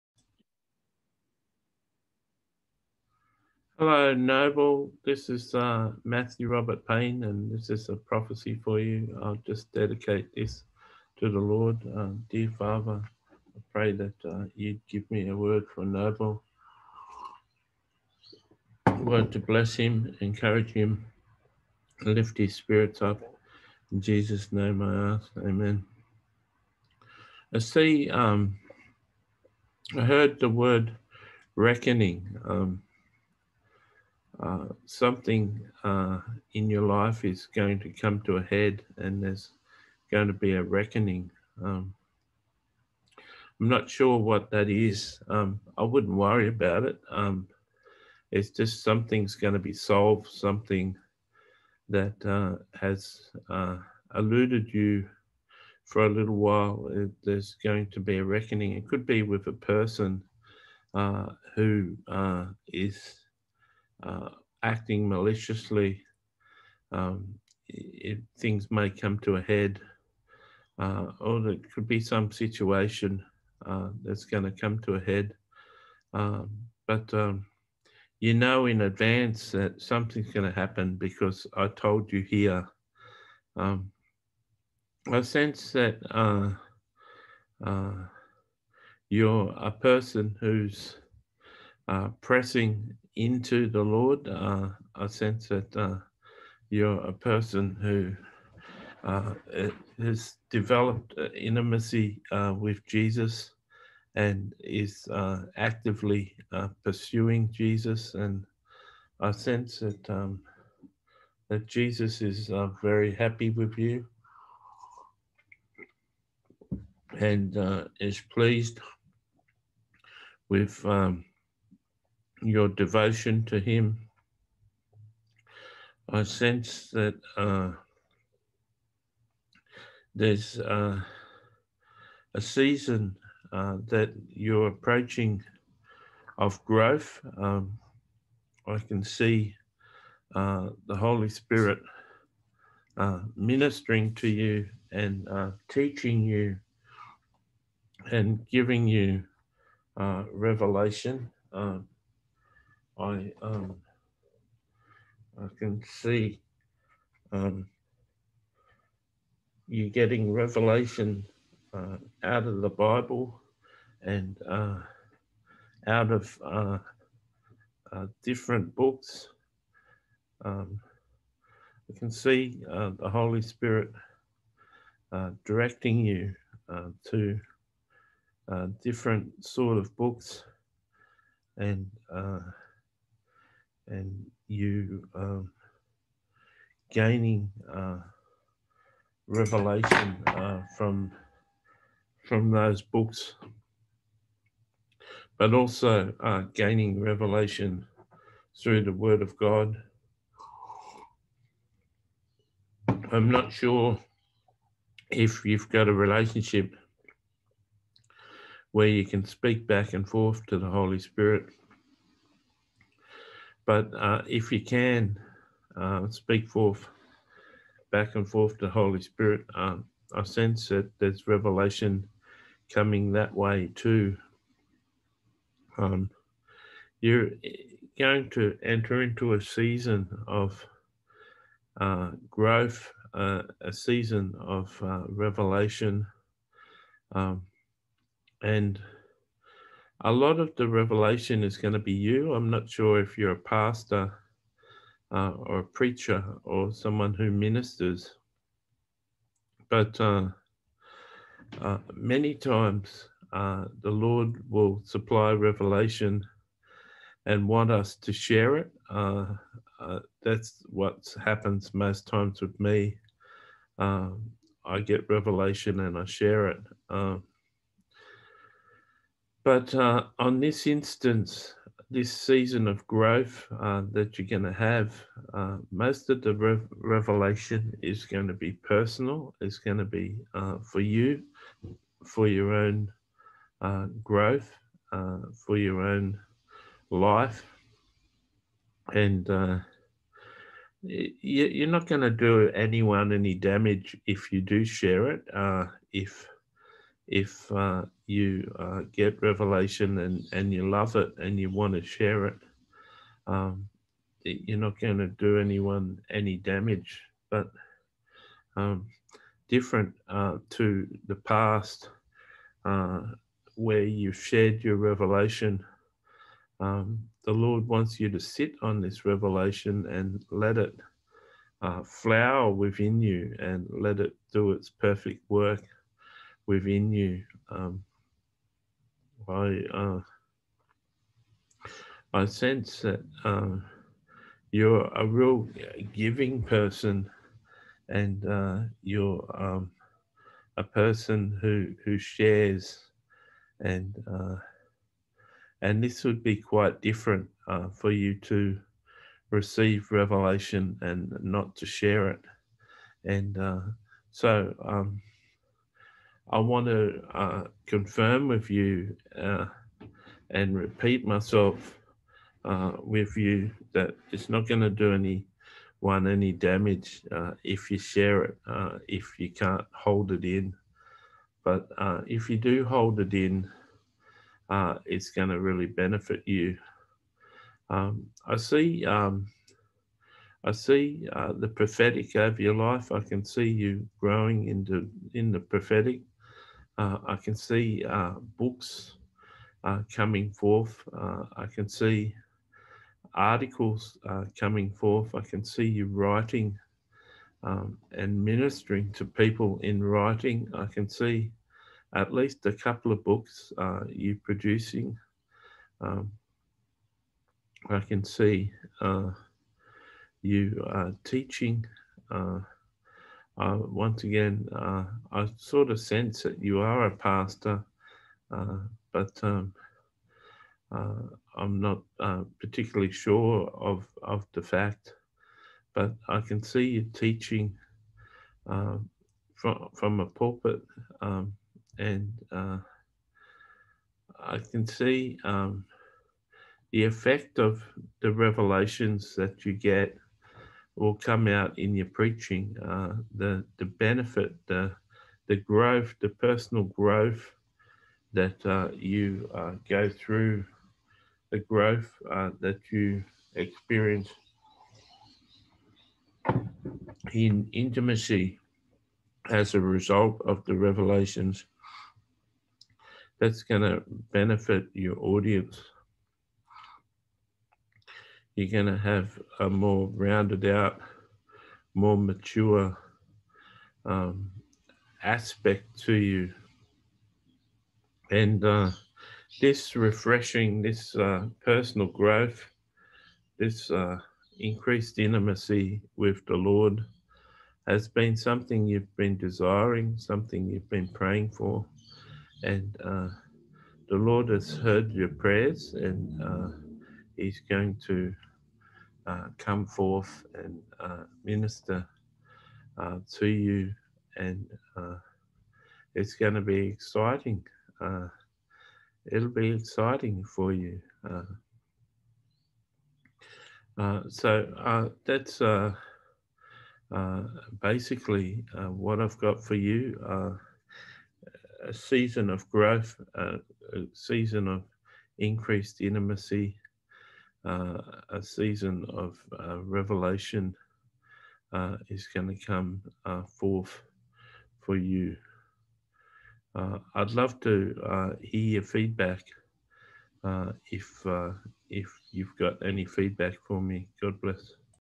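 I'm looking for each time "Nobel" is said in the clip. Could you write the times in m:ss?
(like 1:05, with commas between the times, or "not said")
0:04, 0:15.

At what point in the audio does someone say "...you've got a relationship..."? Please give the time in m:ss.
3:25.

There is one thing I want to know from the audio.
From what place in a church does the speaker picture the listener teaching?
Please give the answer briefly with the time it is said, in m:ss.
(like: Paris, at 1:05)
A pulpit, at 7:10.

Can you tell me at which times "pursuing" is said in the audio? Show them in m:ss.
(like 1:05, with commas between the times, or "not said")
1:46.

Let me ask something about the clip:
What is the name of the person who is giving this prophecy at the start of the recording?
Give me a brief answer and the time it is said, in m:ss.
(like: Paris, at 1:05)
Matthew Robert Payne, at 0:06.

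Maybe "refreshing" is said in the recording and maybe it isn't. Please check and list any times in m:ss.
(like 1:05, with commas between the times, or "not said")
7:59.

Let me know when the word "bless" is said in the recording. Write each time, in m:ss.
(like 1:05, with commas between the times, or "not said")
0:19, 9:04.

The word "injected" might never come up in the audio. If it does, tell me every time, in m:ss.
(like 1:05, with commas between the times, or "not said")
not said.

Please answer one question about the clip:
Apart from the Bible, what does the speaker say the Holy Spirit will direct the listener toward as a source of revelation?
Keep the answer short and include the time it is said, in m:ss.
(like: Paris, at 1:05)
Different books, at 2:48.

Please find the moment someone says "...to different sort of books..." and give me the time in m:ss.
2:57.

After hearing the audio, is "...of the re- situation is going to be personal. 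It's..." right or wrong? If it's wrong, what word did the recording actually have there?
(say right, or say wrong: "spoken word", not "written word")
wrong: "revelation", not "situation".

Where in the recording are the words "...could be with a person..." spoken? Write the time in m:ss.
0:58.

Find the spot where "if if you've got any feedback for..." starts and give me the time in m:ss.
9:00.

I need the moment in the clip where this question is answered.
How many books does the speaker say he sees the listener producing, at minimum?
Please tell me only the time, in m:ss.
6:42.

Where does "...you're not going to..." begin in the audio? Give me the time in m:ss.
5:04.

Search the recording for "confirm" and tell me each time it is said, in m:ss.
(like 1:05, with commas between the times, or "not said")
5:57.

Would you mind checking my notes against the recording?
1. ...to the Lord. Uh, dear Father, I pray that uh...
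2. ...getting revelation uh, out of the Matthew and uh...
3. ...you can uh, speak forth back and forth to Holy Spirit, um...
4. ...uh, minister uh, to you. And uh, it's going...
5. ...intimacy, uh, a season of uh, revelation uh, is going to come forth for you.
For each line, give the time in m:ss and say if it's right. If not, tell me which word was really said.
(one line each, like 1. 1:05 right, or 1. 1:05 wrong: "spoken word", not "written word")
1. 0:11 right
2. 2:39 wrong: "Bible", not "Matthew"
3. 3:34 right
4. 8:20 right
5. 8:45 right.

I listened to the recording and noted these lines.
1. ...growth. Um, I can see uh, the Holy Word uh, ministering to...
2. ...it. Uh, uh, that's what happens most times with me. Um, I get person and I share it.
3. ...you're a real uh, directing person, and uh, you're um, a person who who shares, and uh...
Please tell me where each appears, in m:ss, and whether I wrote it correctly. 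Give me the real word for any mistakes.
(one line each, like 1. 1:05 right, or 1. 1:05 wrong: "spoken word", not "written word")
1. 2:16 wrong: "Spirit", not "Word"
2. 4:18 wrong: "revelation", not "person"
3. 5:34 wrong: "giving", not "directing".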